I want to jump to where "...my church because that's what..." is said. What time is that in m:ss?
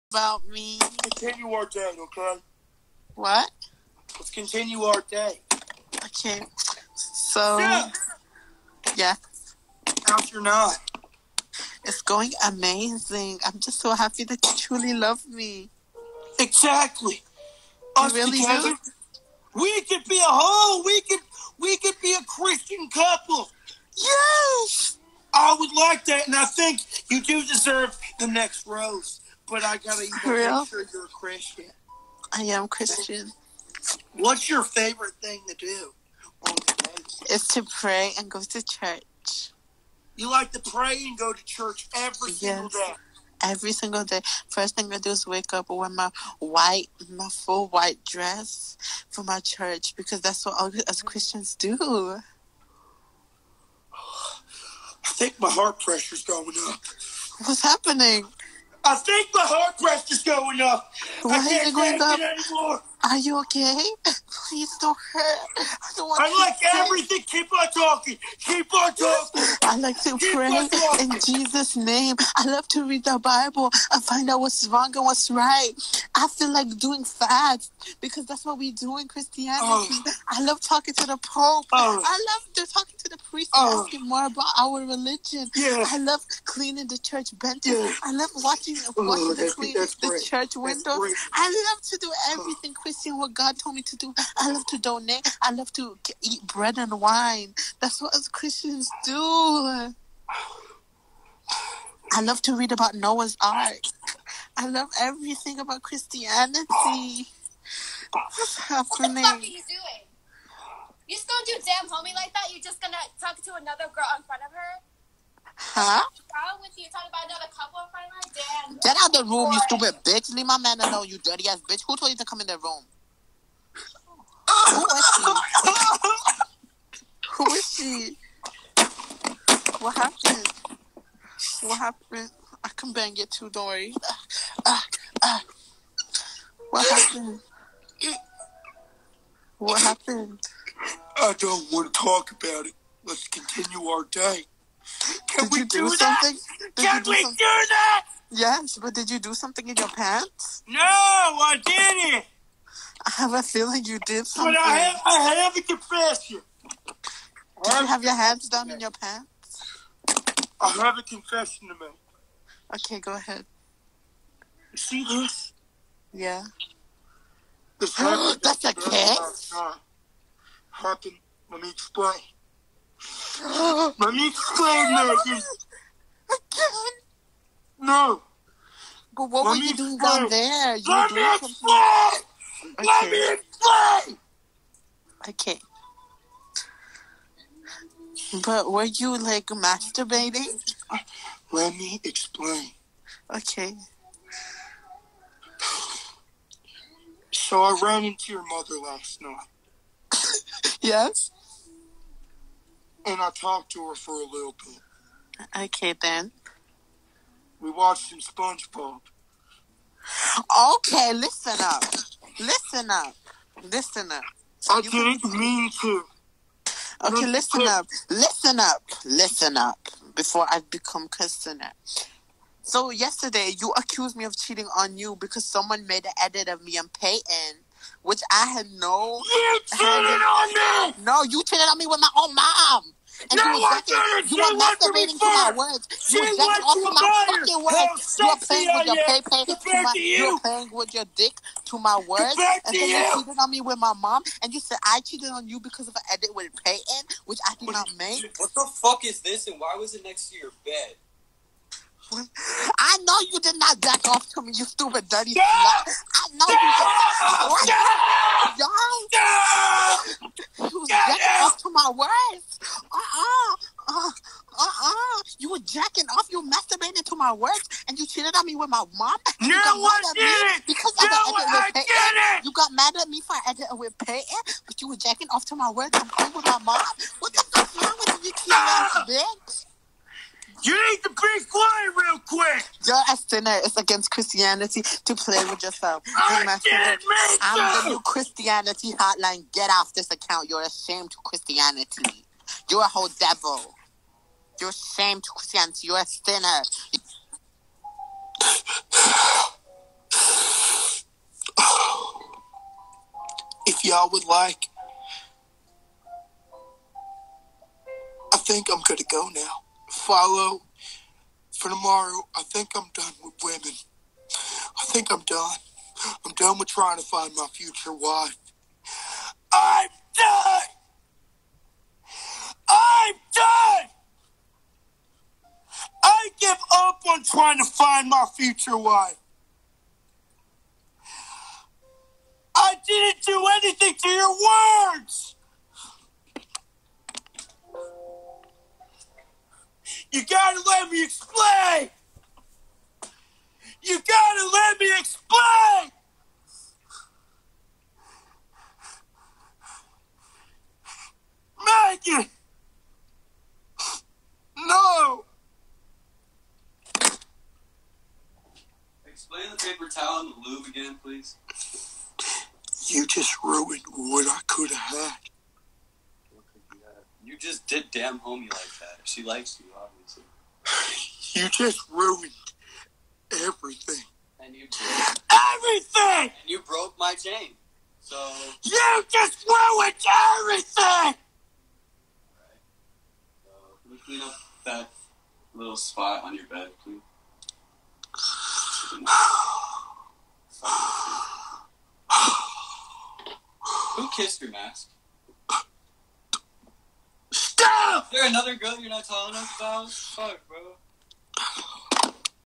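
0:49.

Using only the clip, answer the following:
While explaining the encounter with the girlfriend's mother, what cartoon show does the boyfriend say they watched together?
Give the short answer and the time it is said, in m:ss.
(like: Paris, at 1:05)
SpongeBob, at 3:28.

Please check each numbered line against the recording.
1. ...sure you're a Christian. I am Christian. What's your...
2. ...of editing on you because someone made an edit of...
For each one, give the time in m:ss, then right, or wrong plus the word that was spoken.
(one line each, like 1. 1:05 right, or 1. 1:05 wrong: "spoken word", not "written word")
1. 0:30 right
2. 3:44 wrong: "cheating", not "editing".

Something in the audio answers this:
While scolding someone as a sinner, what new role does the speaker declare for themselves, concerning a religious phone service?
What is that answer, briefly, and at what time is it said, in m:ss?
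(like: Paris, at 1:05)
The new Christianity hotline, at 4:47.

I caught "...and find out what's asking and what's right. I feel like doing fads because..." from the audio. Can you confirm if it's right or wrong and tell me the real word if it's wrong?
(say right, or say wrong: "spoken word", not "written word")
wrong: "wrong", not "asking".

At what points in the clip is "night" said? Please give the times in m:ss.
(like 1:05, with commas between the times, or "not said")
0:10, 3:19.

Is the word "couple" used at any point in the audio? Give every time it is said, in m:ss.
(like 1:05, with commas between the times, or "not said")
0:22, 1:57.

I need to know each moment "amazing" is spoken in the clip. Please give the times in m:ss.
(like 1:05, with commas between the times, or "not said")
0:12.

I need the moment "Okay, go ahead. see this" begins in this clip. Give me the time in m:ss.
2:42.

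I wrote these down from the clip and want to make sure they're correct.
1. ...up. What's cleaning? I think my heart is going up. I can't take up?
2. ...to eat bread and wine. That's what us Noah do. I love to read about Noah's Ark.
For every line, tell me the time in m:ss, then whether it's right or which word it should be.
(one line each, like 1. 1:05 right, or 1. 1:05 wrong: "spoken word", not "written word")
1. 0:56 wrong: "happening", not "cleaning"
2. 1:35 wrong: "Christians", not "Noah".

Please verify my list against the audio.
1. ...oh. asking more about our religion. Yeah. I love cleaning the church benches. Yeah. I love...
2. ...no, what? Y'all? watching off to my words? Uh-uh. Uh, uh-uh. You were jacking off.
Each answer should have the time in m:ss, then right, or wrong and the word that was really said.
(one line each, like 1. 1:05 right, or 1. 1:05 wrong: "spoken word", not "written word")
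1. 1:23 right
2. 4:16 wrong: "jacking", not "watching".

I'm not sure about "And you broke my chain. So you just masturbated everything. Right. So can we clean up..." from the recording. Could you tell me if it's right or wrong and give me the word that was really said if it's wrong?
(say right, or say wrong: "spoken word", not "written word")
wrong: "ruined", not "masturbated".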